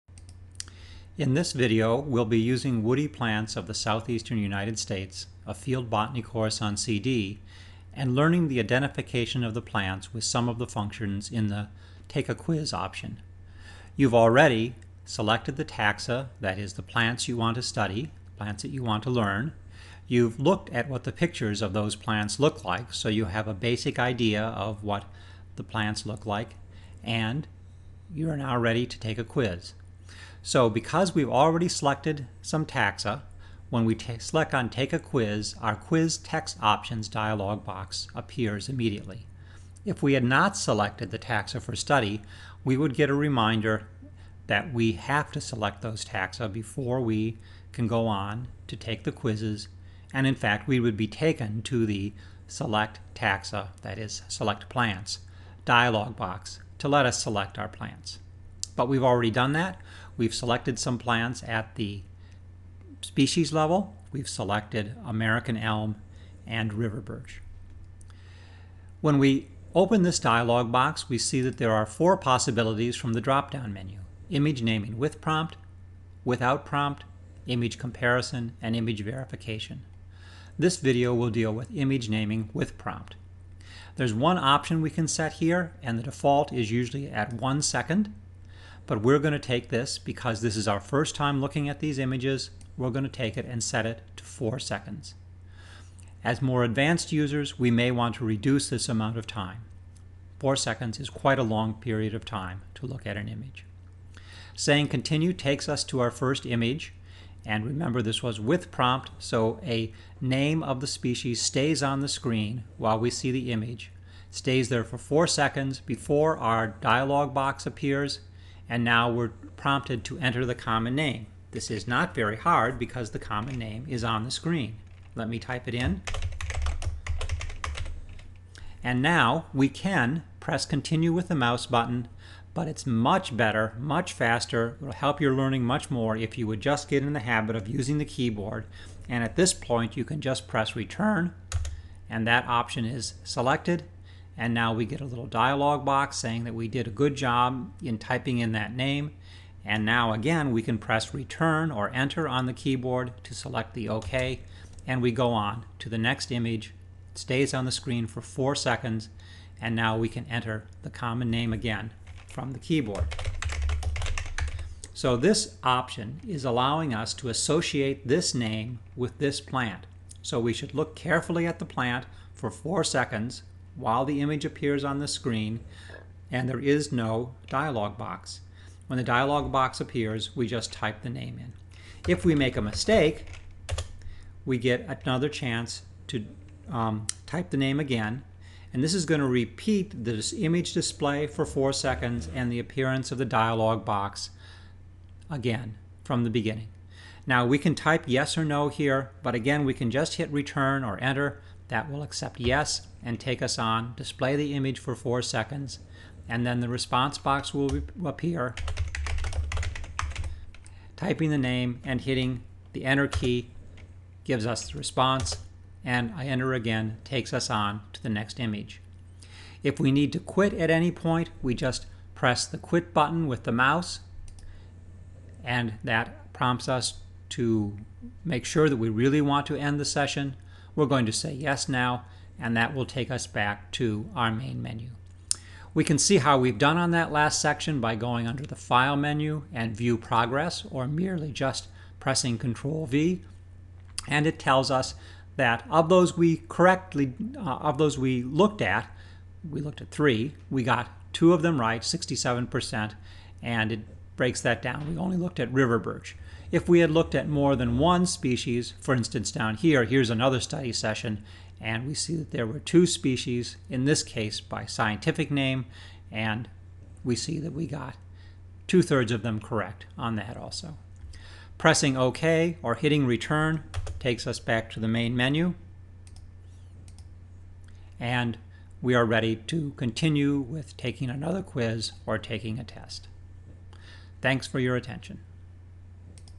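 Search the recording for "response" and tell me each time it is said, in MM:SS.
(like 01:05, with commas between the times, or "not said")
03:26, 03:34.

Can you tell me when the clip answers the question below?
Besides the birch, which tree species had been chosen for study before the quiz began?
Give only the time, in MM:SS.
01:05.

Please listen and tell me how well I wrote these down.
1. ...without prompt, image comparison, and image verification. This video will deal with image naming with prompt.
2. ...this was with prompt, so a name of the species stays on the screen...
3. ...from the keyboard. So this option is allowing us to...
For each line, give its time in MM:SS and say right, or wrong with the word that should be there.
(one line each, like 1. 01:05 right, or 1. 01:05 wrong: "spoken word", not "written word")
1. 01:16 right
2. 01:48 right
3. 02:42 right.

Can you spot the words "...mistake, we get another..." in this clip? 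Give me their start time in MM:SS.
03:02.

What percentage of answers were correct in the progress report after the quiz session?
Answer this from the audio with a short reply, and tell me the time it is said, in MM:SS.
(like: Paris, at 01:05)
67%, at 04:11.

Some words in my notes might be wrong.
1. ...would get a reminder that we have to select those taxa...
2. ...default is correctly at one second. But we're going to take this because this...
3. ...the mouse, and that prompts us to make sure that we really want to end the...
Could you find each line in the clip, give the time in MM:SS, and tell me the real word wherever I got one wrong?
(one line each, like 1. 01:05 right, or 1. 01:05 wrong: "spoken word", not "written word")
1. 00:42 right
2. 01:26 wrong: "usually", not "correctly"
3. 03:43 right.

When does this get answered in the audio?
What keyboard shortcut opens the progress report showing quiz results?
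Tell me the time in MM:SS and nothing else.
04:02.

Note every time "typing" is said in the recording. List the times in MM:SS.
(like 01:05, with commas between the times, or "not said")
02:27, 03:30.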